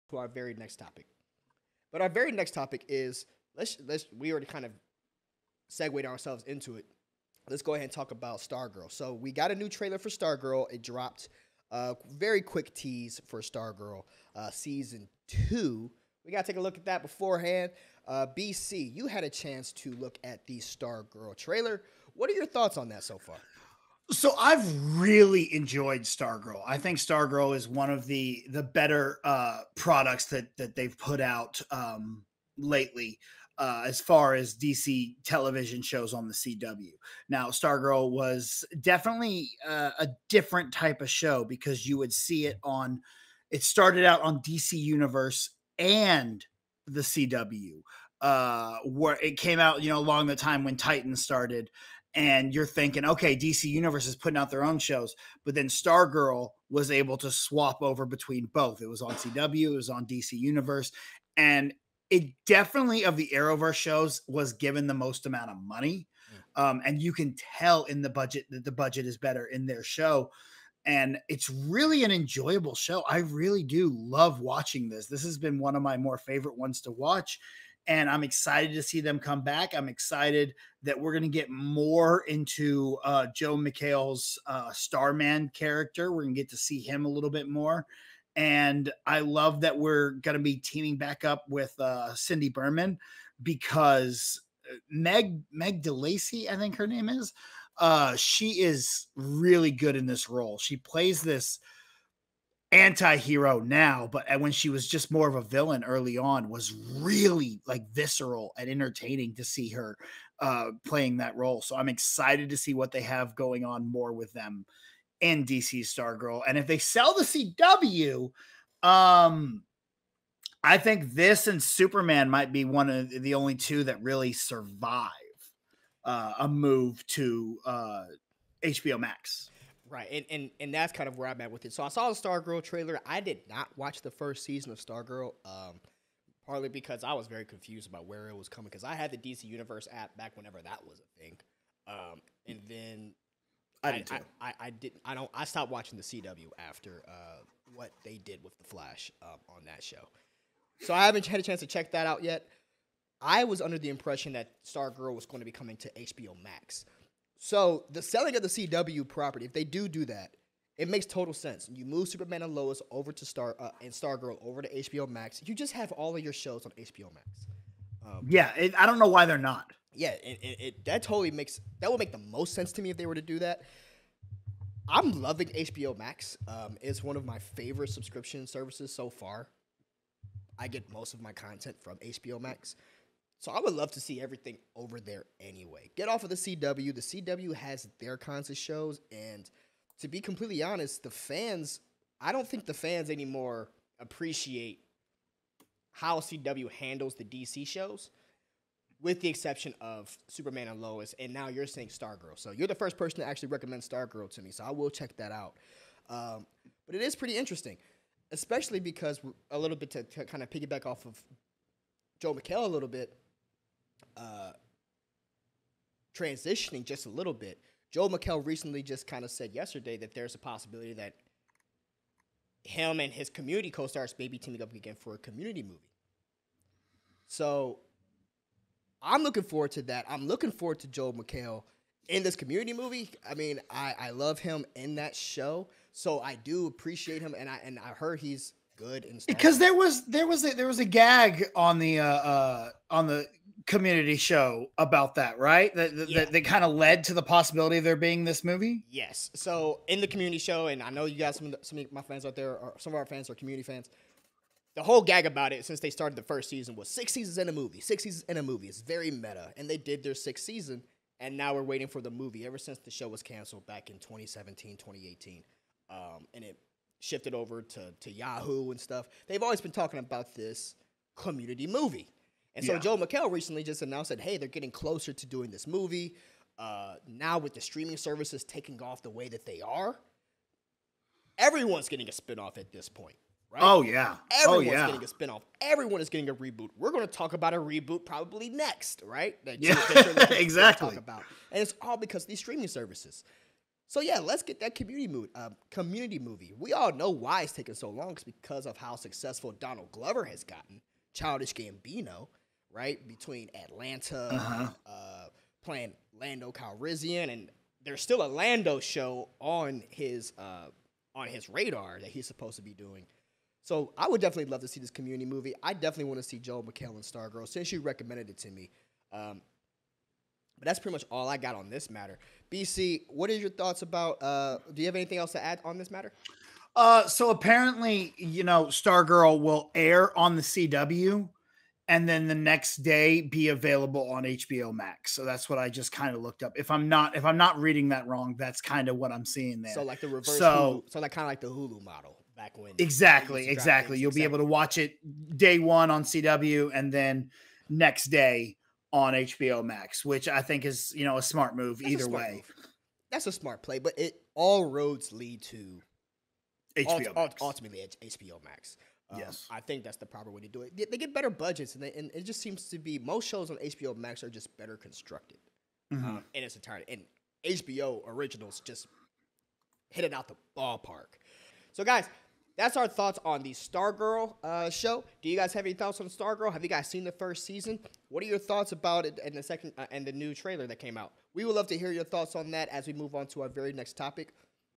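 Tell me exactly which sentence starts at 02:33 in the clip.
I was under the impression that Stargirl was going to be coming to HBO Max.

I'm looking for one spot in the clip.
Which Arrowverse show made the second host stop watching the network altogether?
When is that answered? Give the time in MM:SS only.
02:28.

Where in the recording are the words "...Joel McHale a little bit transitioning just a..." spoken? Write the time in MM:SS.
03:32.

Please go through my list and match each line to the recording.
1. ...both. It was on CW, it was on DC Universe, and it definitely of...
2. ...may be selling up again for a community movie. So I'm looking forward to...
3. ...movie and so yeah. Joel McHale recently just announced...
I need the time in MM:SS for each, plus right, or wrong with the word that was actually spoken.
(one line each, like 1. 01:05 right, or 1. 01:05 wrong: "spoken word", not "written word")
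1. 00:58 right
2. 03:44 wrong: "teaming", not "selling"
3. 04:31 right.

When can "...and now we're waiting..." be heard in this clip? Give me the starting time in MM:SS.
04:21.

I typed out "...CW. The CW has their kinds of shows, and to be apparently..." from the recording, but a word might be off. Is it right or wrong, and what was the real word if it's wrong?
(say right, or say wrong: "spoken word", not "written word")
wrong: "completely", not "apparently".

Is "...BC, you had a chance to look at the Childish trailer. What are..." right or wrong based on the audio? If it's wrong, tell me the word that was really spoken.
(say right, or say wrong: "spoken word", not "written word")
wrong: "Stargirl", not "Childish".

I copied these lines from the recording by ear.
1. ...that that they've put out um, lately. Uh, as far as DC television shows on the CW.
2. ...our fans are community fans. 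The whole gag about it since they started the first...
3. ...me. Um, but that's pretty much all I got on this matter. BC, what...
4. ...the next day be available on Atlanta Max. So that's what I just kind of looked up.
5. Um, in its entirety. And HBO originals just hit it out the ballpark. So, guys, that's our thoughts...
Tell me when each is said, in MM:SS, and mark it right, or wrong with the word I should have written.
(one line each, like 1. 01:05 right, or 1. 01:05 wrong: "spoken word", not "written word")
1. 00:30 right
2. 04:12 right
3. 05:18 right
4. 05:32 wrong: "HBO", not "Atlanta"
5. 06:06 right.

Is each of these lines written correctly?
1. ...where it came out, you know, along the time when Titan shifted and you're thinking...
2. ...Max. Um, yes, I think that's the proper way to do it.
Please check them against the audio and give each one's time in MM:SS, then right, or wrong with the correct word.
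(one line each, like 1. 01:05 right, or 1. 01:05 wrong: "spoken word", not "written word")
1. 00:48 wrong: "started", not "shifted"
2. 05:58 right.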